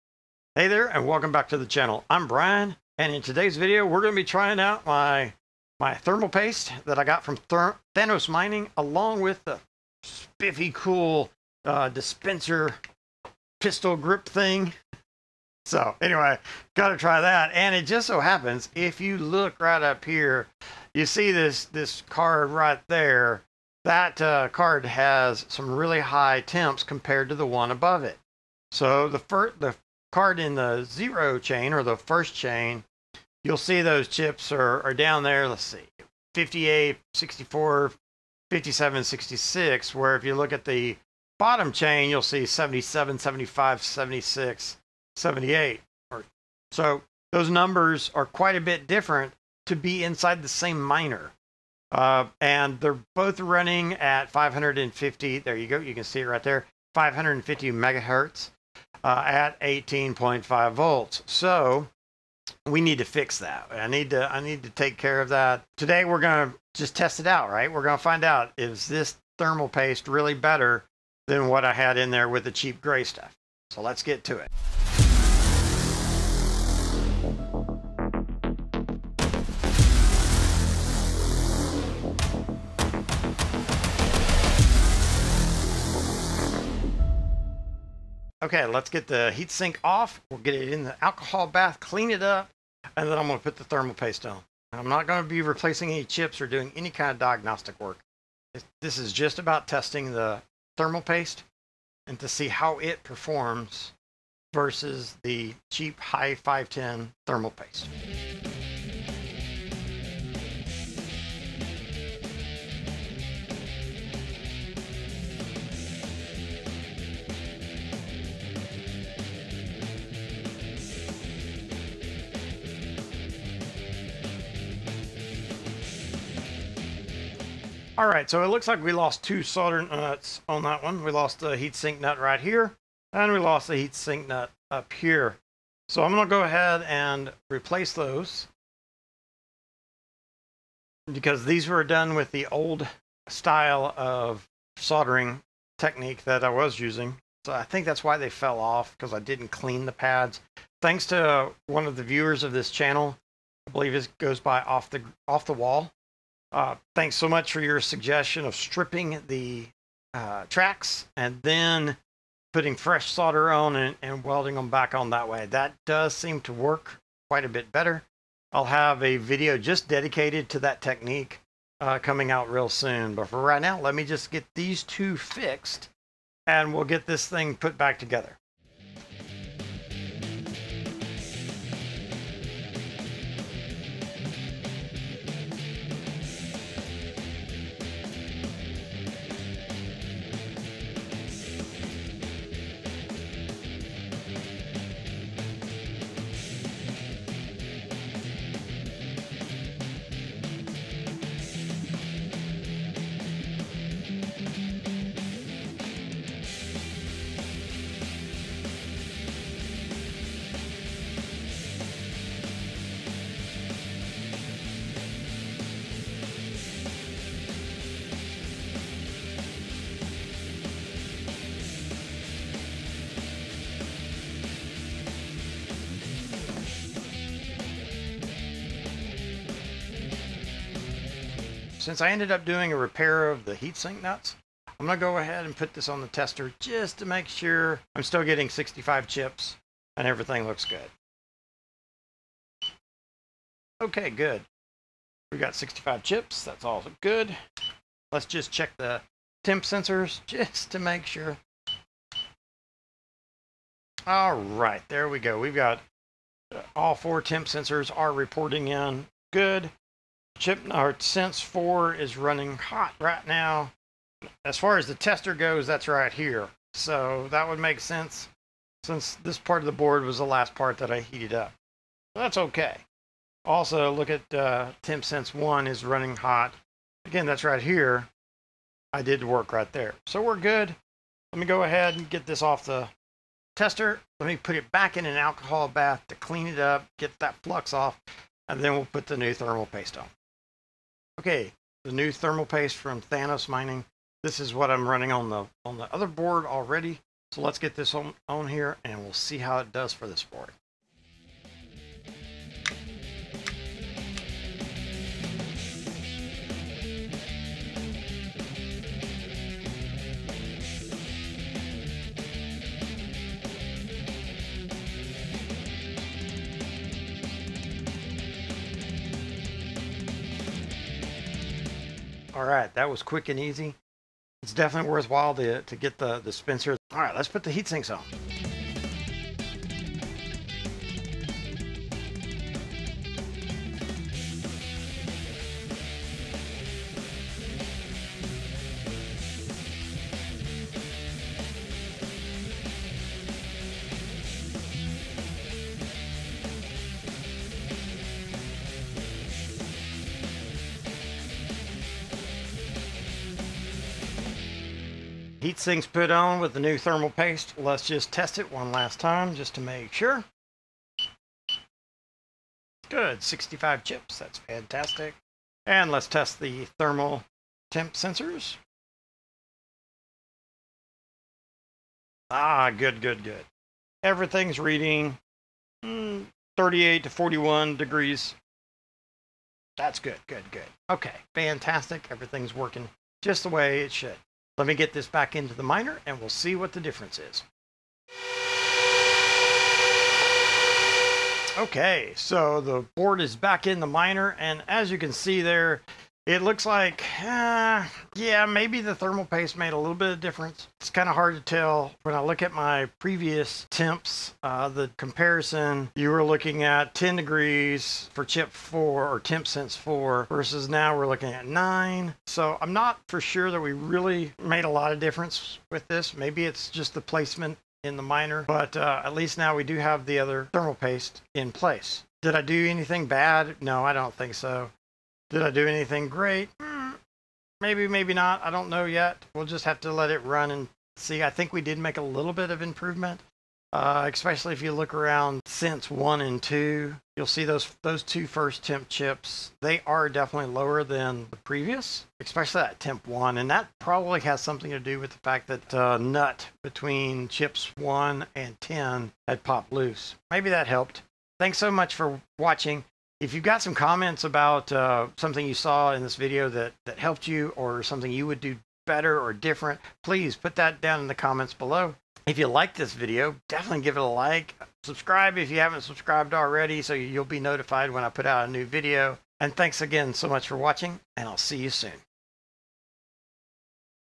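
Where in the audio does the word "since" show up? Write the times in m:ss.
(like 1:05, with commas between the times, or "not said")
3:51, 4:28, 7:15.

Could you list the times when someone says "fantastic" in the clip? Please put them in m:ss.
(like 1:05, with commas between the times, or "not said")
6:04, 6:21.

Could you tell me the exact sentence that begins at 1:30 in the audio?
We'll get it in the alcohol bath, clean it up, and then I'm going to put the thermal paste on.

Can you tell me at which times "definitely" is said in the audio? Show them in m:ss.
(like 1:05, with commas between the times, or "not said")
5:24, 7:20, 7:43.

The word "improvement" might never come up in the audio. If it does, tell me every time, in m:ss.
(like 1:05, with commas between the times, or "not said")
7:12.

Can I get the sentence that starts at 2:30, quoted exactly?
Thanks to one of the viewers of this channel, I believe it goes by off the off the wall.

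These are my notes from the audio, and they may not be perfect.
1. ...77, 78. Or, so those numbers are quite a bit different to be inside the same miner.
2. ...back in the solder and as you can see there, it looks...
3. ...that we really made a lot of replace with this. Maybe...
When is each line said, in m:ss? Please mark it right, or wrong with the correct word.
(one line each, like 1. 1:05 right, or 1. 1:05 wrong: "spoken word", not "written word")
1. 0:43 wrong: "76", not "77"
2. 6:33 wrong: "miner", not "solder"
3. 6:53 wrong: "difference", not "replace".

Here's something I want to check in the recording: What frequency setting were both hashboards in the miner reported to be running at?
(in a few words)
550 MHz.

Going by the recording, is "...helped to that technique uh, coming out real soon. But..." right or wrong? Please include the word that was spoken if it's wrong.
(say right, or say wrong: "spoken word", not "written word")
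wrong: "dedicated", not "helped".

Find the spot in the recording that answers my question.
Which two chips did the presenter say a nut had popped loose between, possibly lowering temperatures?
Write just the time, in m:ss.
7:27.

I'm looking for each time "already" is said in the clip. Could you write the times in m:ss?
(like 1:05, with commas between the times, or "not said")
4:56, 7:46.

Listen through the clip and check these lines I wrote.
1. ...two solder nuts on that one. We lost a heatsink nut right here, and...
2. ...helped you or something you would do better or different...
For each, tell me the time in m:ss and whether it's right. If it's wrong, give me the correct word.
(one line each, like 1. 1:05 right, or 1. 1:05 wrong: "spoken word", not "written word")
1. 2:09 right
2. 7:36 right.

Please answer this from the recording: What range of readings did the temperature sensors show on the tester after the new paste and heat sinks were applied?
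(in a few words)
38 to 41 degrees.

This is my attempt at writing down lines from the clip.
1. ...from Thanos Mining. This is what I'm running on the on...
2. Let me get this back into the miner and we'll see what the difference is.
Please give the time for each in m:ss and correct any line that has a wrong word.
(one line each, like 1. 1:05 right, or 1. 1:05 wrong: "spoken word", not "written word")
1. 4:52 right
2. 6:24 right.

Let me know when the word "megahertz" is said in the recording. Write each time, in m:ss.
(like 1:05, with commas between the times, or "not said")
0:57.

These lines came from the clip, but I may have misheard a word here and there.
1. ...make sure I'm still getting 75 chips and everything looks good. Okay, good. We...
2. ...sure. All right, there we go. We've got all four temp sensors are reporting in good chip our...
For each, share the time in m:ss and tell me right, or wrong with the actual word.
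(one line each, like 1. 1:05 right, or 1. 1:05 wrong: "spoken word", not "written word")
1. 3:57 wrong: "65", not "75"
2. 4:11 right.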